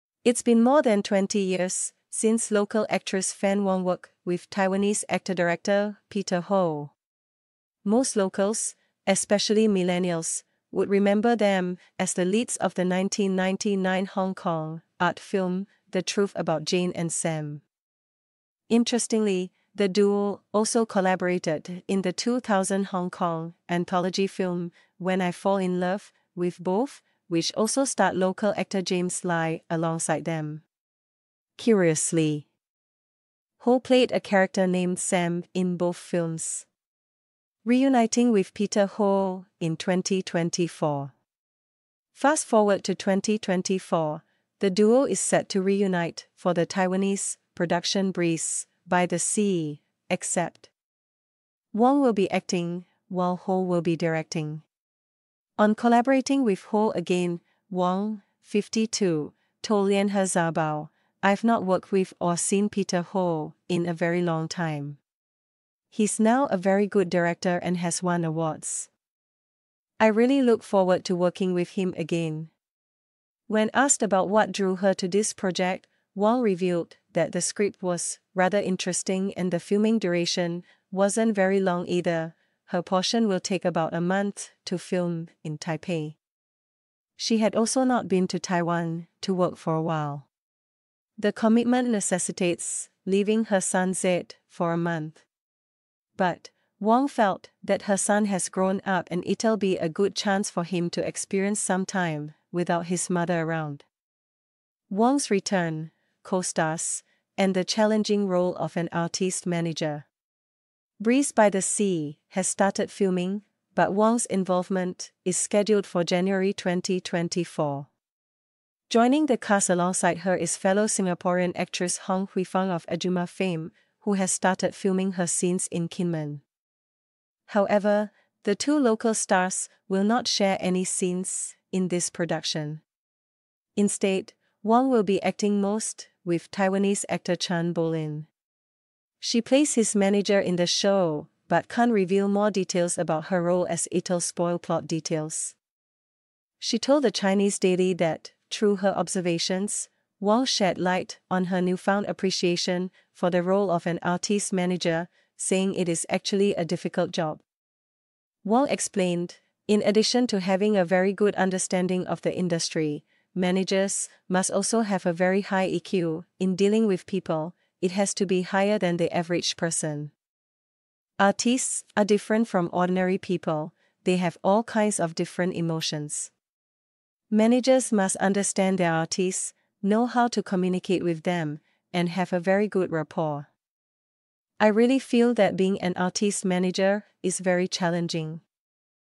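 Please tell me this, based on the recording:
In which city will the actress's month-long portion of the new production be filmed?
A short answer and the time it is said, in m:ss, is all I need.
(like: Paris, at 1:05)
Taipei, at 1:25.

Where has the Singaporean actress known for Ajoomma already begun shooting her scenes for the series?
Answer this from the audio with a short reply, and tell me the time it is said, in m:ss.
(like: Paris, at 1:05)
Kinmen, at 2:05.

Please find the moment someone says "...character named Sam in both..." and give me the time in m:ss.
0:34.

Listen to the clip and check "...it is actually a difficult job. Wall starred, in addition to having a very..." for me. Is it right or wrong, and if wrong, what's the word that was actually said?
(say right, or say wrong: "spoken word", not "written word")
wrong: "explained", not "starred".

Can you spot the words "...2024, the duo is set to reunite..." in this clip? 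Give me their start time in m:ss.
0:42.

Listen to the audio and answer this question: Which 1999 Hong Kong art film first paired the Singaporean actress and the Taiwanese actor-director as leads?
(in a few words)
The Truth About Jane and Sam.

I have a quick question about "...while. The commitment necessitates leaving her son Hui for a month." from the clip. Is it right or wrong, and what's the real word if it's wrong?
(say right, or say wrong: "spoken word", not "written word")
wrong: "Zed", not "Hui".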